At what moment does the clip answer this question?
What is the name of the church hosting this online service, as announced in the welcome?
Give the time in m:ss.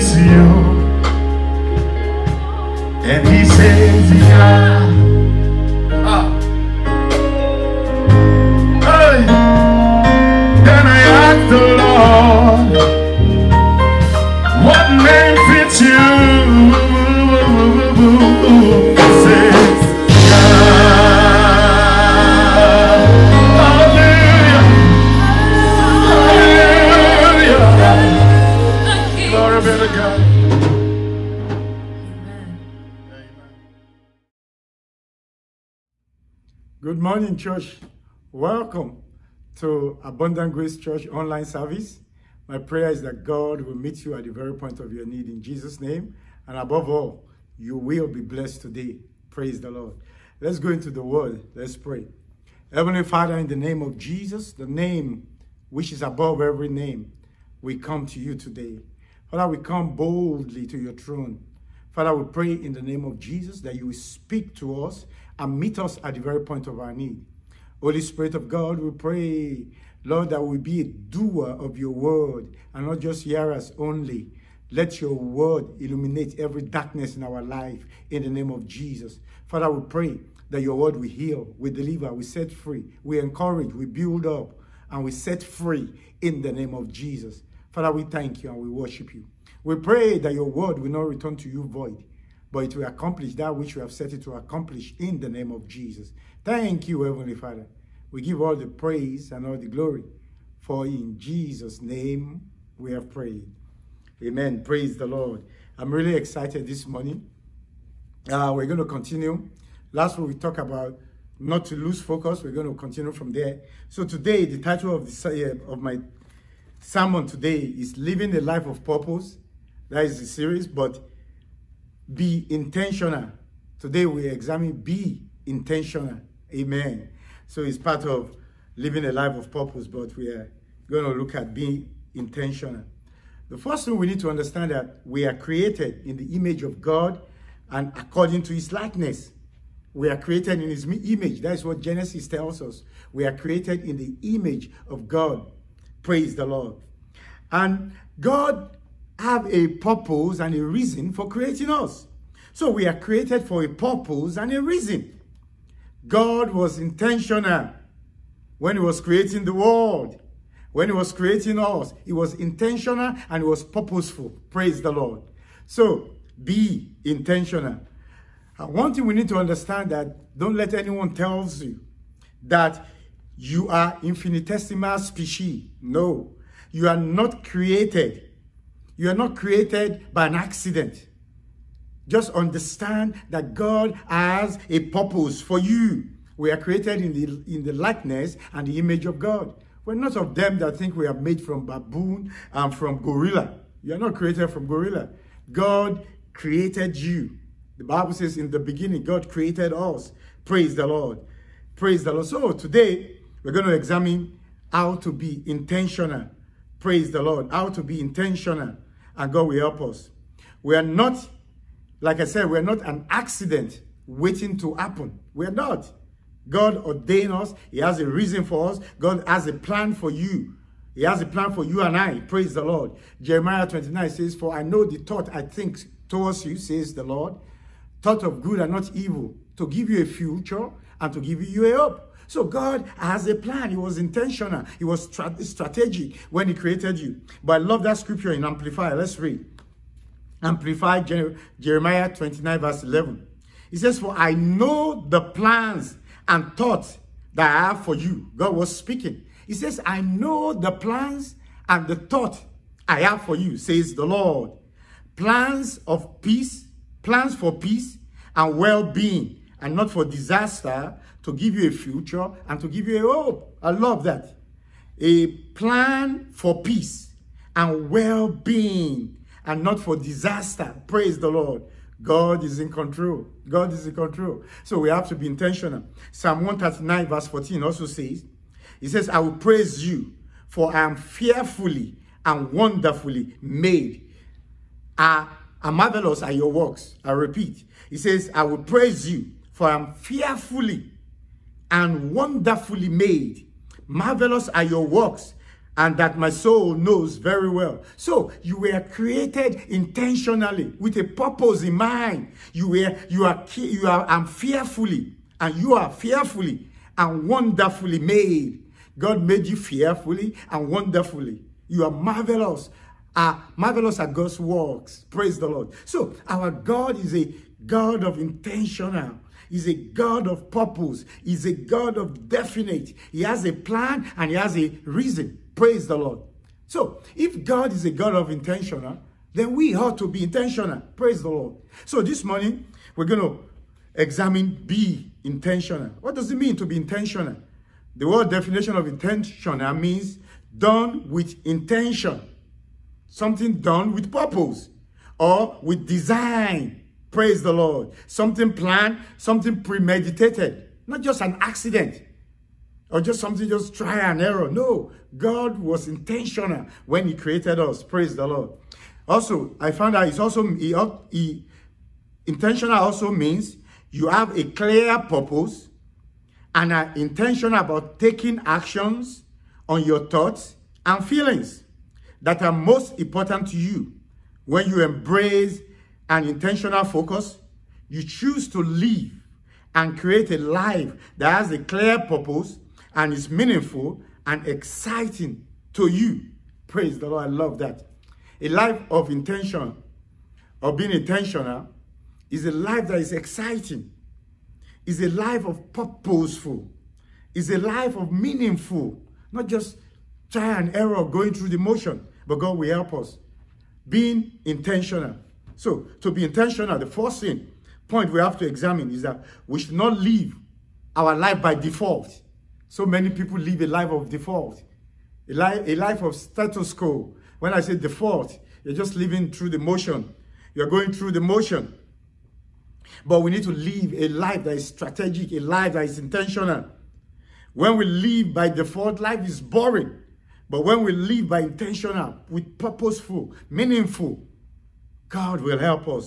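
0:40.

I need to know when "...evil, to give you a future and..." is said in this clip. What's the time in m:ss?
3:48.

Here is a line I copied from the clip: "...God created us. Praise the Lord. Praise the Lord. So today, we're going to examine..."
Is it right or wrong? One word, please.
right.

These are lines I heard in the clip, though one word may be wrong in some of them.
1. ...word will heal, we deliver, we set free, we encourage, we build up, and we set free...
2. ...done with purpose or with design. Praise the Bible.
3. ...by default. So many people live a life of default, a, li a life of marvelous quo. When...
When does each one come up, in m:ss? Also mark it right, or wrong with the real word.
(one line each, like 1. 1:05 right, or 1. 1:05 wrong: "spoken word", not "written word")
1. 1:20 right
2. 5:43 wrong: "Lord", not "Bible"
3. 6:51 wrong: "status", not "marvelous".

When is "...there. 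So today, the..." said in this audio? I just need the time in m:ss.
1:53.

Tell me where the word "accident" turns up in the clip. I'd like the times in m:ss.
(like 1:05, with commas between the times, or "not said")
3:00, 3:33, 5:51.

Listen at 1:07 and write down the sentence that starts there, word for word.
Holy Spirit of God, we pray, Lord, that we be a doer of your word and not just hearers only.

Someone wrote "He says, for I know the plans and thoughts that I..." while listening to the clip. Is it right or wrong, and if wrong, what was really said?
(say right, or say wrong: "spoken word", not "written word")
right.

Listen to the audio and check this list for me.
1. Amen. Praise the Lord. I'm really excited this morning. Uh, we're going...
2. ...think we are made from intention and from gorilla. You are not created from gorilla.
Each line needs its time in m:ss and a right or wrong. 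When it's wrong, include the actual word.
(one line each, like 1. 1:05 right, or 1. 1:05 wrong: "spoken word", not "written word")
1. 1:44 right
2. 3:10 wrong: "baboon", not "intention".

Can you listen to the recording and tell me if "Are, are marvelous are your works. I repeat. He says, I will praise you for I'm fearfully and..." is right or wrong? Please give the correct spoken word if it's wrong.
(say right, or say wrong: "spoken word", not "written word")
right.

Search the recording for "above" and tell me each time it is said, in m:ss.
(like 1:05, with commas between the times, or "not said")
0:46, 0:56.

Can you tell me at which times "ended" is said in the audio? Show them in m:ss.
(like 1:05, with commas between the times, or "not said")
not said.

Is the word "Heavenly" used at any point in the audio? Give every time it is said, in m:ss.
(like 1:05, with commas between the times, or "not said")
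0:52, 1:37.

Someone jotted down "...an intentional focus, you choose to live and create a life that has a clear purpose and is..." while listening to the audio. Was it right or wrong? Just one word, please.
right.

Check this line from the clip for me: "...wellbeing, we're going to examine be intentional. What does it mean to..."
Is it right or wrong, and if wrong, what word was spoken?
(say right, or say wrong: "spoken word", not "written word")
wrong: "morning", not "wellbeing".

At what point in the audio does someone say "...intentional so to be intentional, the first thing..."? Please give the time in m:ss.
6:44.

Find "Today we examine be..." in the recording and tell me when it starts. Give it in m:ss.
2:03.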